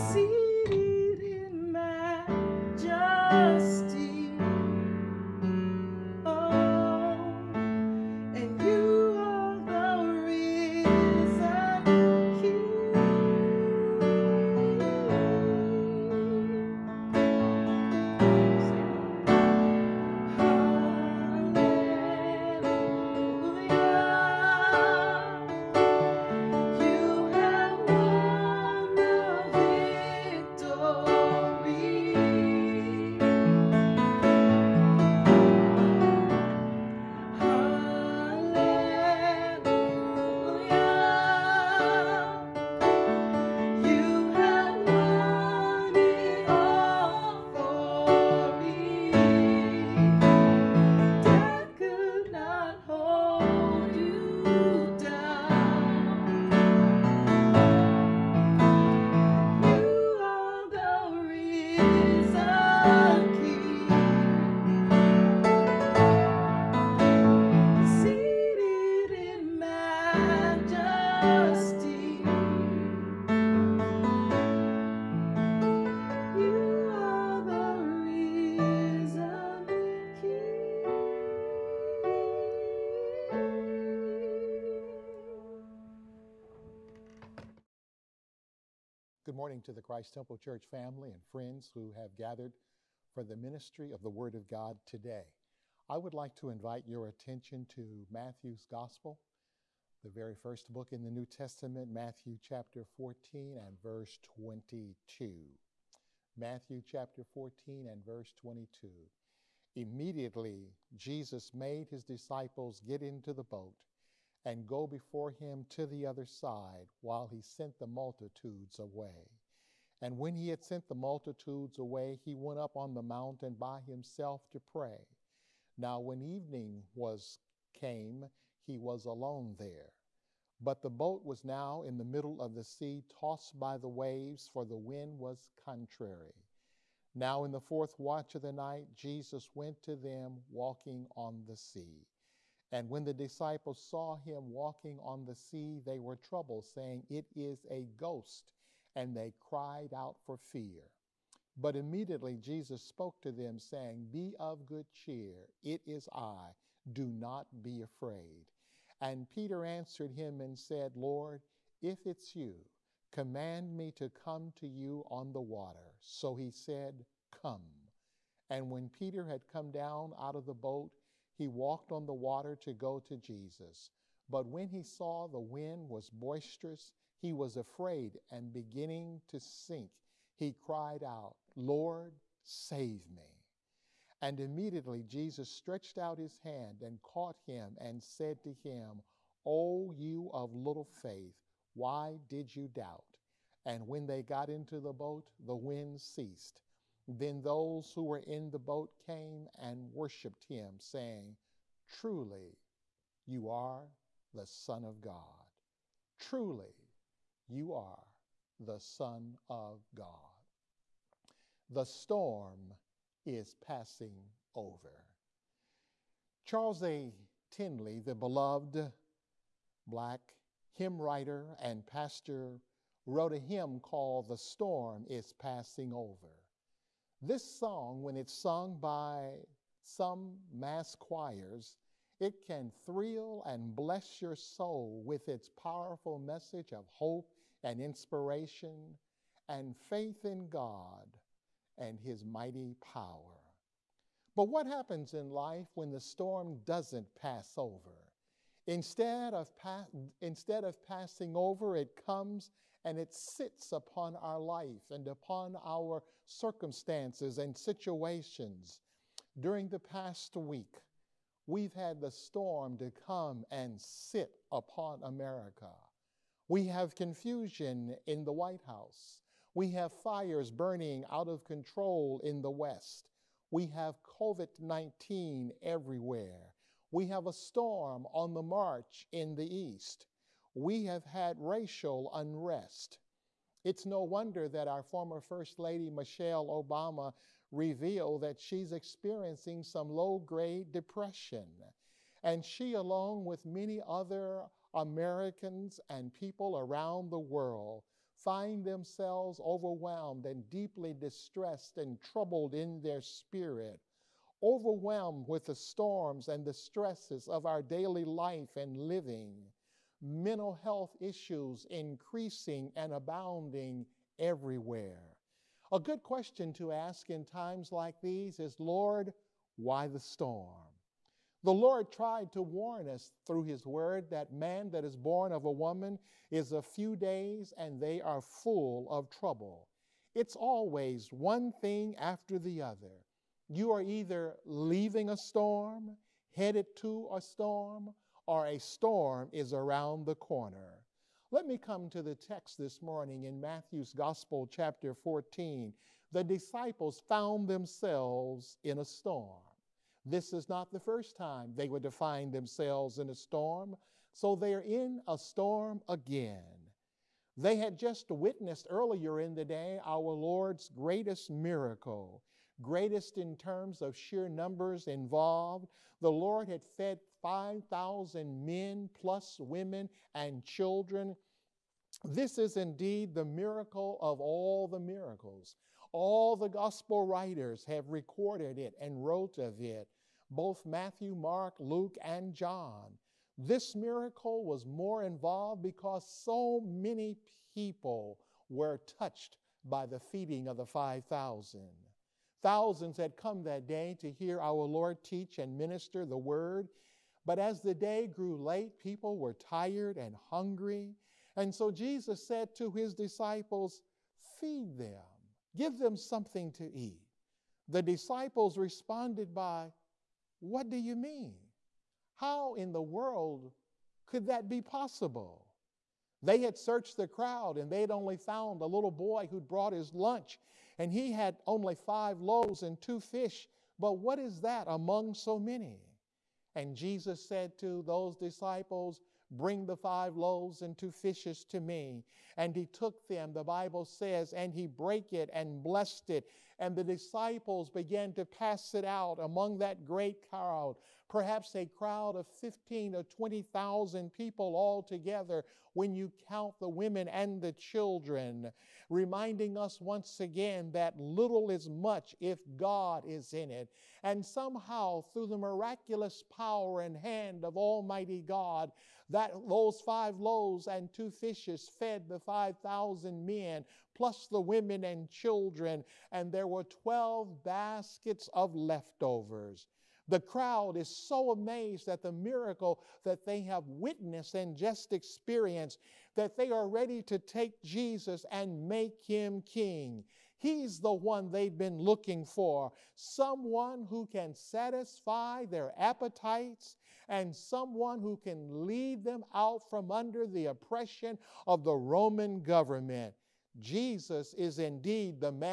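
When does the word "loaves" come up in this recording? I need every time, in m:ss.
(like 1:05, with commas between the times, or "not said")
7:02, 7:10, 7:40.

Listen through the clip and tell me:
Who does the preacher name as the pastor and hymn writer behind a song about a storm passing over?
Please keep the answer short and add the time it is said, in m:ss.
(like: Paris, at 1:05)
Charles A. Tindley, at 3:36.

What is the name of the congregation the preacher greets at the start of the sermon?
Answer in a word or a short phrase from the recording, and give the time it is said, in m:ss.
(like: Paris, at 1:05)
Christ Temple Church, at 1:29.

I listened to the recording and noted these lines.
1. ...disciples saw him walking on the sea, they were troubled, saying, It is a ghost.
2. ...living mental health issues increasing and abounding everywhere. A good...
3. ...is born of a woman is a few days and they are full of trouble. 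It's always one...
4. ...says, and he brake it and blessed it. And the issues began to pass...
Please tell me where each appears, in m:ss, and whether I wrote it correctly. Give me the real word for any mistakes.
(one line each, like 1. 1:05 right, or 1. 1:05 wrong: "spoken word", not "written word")
1. 2:23 right
2. 5:08 right
3. 5:24 right
4. 7:13 wrong: "disciples", not "issues".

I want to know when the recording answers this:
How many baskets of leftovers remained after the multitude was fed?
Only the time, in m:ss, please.
7:46.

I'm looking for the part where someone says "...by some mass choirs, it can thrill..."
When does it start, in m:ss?
3:48.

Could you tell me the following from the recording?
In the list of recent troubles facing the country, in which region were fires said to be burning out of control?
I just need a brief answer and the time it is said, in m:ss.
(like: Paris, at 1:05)
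the West, at 4:32.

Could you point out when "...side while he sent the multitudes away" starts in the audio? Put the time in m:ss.
1:56.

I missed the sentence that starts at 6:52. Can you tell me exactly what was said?
How in the world could that be possible?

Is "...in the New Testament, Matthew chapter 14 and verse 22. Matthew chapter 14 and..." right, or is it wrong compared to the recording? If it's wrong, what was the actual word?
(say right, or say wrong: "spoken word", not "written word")
right.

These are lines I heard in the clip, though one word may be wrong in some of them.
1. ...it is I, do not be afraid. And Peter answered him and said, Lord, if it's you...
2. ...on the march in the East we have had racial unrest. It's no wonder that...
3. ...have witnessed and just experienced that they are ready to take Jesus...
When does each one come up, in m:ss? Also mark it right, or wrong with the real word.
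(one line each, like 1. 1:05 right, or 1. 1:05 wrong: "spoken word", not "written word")
1. 2:35 right
2. 4:38 right
3. 7:53 right.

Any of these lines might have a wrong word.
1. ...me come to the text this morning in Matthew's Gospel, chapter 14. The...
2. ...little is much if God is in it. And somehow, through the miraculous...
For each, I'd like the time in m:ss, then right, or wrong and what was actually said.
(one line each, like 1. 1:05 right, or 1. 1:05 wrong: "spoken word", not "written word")
1. 5:41 right
2. 7:30 right.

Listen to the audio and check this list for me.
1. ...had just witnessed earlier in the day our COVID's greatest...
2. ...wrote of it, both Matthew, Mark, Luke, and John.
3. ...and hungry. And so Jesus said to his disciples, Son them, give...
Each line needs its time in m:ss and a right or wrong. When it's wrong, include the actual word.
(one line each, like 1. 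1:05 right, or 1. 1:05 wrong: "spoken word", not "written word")
1. 5:57 wrong: "Lord", not "COVID"
2. 6:19 right
3. 6:39 wrong: "Feed", not "Son".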